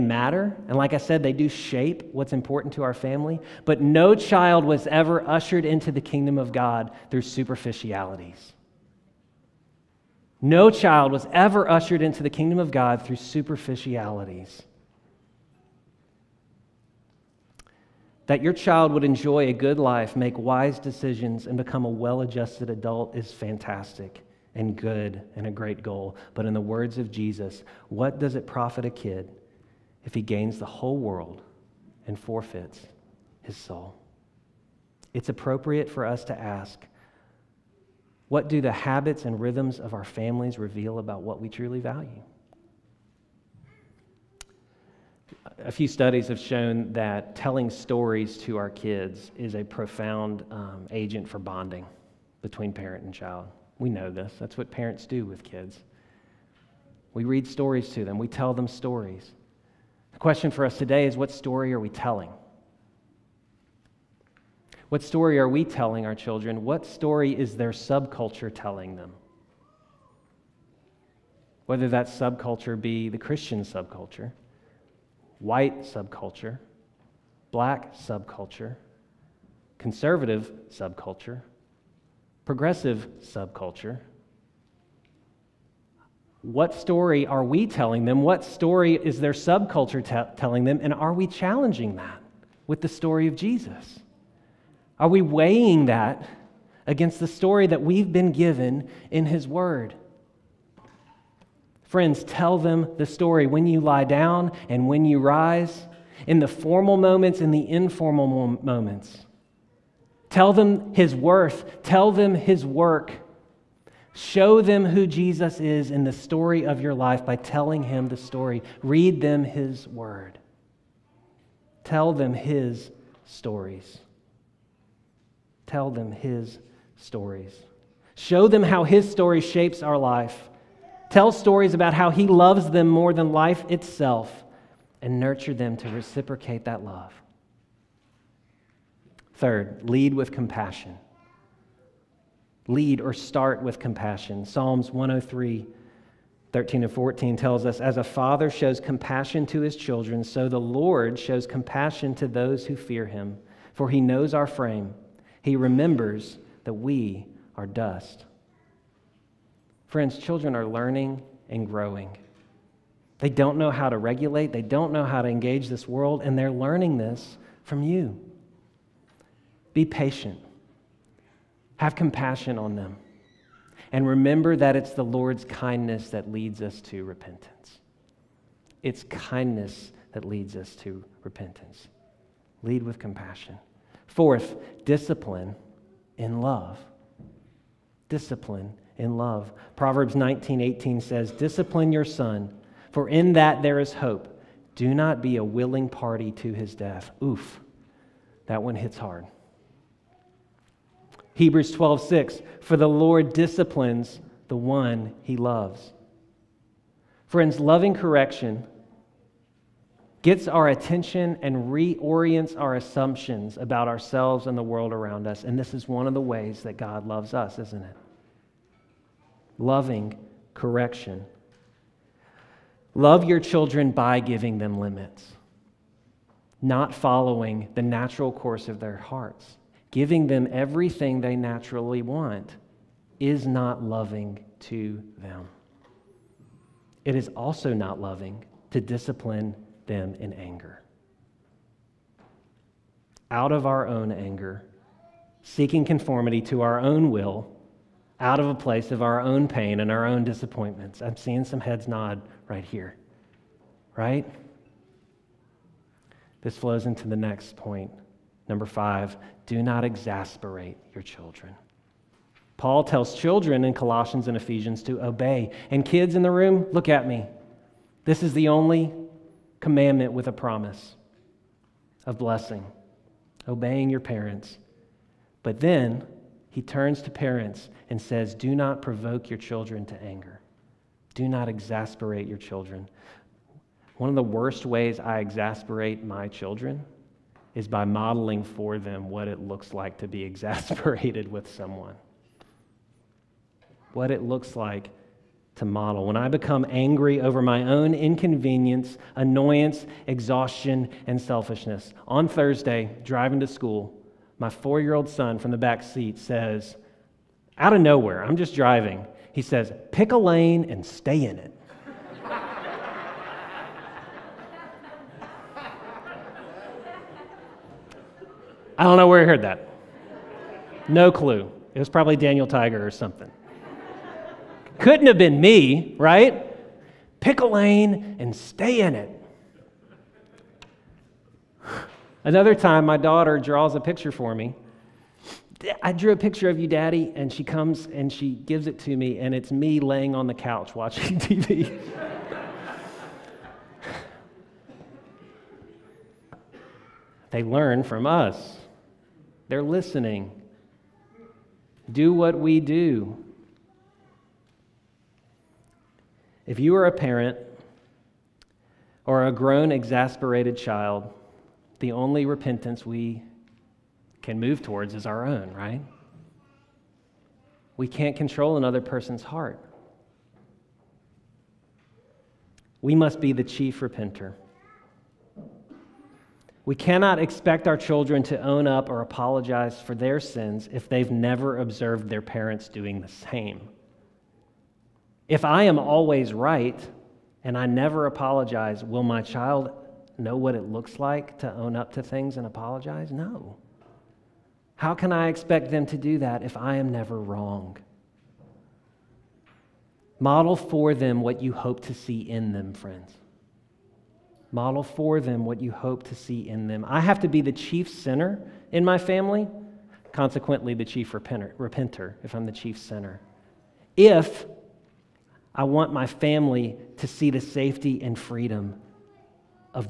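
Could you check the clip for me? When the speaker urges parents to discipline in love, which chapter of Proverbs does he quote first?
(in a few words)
Proverbs 19.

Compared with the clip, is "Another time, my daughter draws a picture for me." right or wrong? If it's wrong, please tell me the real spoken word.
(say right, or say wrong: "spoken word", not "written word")
right.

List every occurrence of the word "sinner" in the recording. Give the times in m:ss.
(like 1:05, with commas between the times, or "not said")
6:47, 6:52.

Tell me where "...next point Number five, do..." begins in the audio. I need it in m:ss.
4:17.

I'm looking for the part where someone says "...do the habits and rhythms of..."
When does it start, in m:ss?
0:38.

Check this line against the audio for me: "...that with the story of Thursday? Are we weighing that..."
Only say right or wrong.
wrong.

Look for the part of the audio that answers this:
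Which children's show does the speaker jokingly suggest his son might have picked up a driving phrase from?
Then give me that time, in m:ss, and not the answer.
5:22.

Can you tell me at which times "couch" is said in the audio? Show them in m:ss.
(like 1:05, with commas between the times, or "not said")
5:40.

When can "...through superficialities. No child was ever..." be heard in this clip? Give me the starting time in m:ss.
0:07.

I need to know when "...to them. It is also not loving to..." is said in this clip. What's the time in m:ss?
3:54.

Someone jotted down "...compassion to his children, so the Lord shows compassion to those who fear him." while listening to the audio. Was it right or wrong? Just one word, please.
right.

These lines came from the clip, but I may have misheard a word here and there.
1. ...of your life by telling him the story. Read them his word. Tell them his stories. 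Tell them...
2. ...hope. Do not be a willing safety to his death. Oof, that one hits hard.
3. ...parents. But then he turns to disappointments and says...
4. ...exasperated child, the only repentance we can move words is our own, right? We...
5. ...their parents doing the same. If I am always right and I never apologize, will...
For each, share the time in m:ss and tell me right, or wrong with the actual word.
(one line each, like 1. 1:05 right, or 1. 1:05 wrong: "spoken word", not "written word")
1. 1:56 right
2. 3:13 wrong: "party", not "safety"
3. 4:34 wrong: "parents", not "disappointments"
4. 5:59 wrong: "towards", not "words"
5. 6:22 right.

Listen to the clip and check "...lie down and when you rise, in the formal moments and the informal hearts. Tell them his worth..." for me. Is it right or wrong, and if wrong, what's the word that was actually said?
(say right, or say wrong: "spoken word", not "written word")
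wrong: "moments", not "hearts".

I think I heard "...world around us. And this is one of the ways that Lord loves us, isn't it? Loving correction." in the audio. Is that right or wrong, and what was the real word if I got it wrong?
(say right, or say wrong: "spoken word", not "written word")
wrong: "God", not "Lord".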